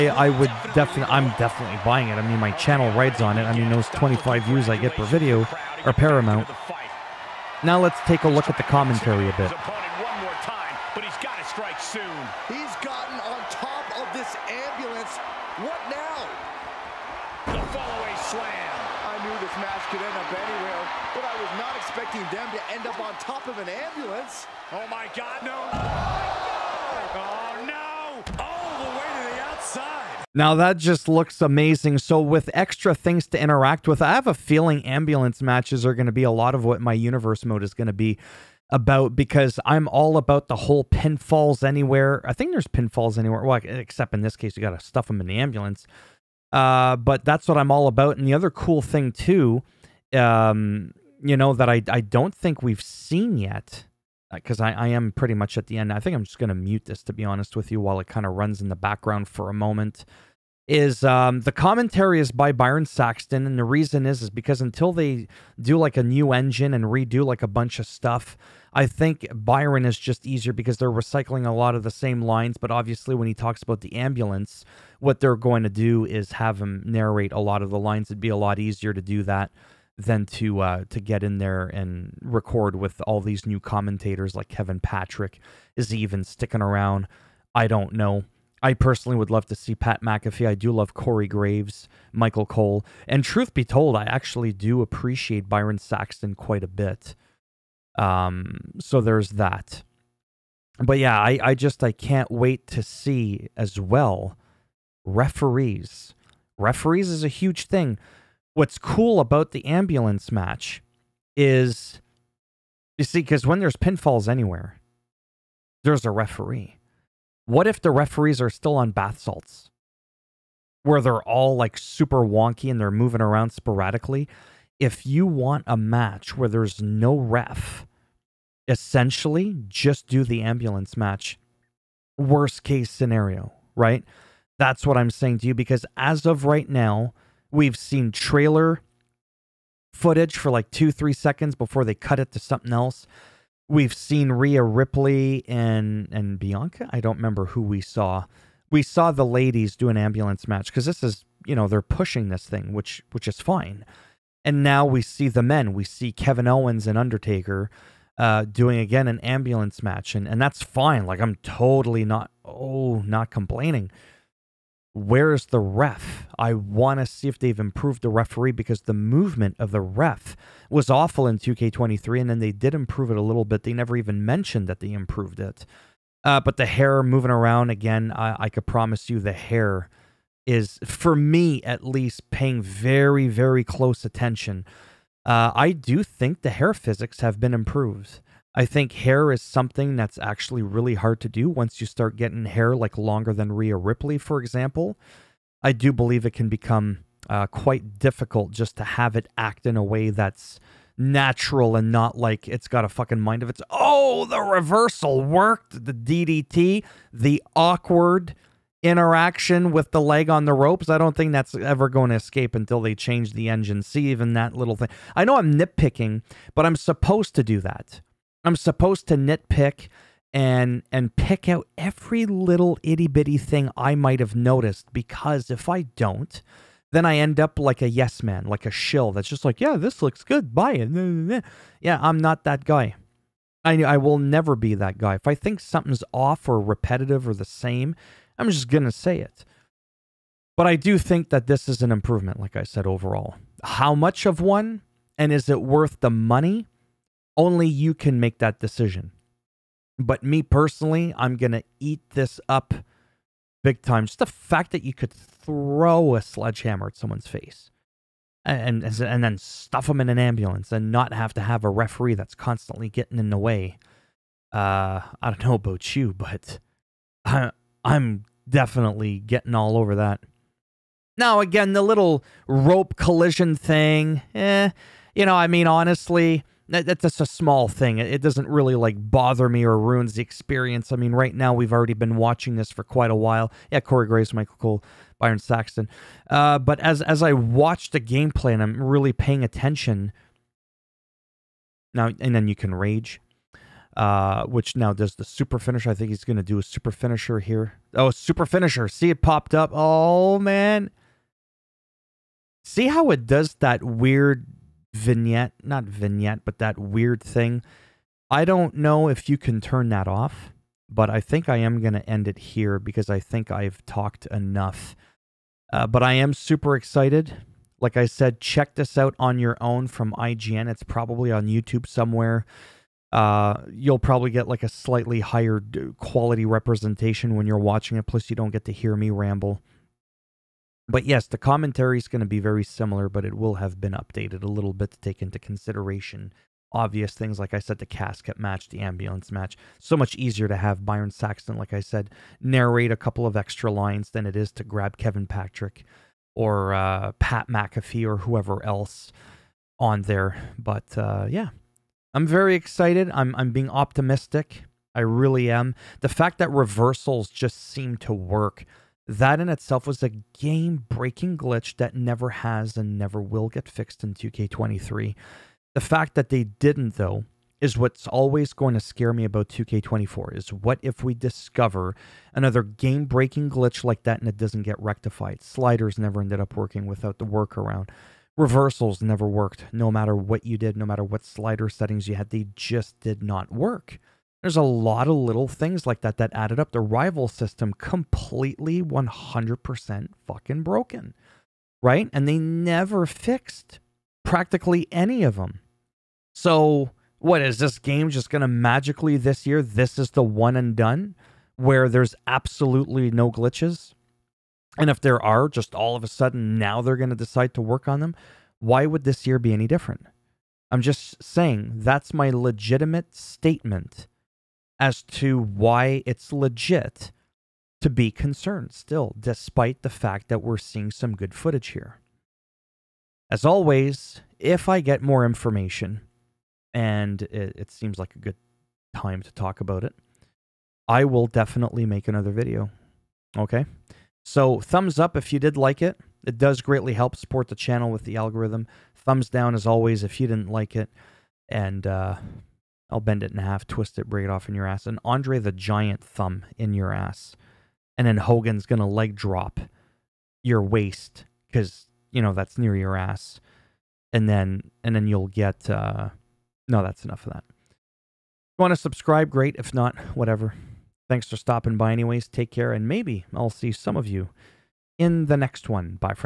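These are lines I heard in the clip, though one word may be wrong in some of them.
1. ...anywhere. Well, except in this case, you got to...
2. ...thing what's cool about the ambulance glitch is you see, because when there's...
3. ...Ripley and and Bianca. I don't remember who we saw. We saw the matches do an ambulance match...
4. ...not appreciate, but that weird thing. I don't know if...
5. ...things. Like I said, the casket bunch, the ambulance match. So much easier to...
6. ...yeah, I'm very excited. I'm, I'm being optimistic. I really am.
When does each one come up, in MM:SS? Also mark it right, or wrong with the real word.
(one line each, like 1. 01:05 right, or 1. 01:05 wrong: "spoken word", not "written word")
1. 00:43 right
2. 01:47 wrong: "match", not "glitch"
3. 02:24 wrong: "ladies", not "matches"
4. 05:05 wrong: "vignette", not "appreciate"
5. 05:37 wrong: "match", not "bunch"
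6. 05:51 right.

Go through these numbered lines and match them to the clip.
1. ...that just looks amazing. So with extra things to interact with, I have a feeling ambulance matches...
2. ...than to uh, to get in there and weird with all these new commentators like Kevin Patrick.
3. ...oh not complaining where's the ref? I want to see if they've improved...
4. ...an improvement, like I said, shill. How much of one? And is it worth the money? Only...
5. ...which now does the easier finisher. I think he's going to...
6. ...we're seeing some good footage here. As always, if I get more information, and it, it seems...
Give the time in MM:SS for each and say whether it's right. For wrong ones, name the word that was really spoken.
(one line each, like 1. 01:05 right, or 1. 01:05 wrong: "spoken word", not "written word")
1. 00:30 right
2. 01:19 wrong: "record", not "weird"
3. 02:42 right
4. 04:01 wrong: "overall", not "shill"
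5. 04:54 wrong: "super", not "easier"
6. 07:00 right.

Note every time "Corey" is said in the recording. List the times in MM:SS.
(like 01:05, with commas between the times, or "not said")
01:30, 04:43.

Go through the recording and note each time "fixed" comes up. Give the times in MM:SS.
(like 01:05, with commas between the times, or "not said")
06:03, 06:33.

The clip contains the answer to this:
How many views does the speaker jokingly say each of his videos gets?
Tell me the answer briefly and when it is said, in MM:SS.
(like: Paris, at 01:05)
25, at 00:03.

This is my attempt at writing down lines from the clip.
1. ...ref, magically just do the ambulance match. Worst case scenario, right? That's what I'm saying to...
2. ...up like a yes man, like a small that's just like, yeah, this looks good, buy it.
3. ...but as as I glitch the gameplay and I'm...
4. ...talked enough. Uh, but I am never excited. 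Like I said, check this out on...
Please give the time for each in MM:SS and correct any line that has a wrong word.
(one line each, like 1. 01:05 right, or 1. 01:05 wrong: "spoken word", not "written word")
1. 02:07 wrong: "essentially", not "magically"
2. 03:47 wrong: "shill", not "small"
3. 04:46 wrong: "watch", not "glitch"
4. 05:13 wrong: "super", not "never".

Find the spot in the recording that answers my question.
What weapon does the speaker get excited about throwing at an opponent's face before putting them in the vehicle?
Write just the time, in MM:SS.
04:16.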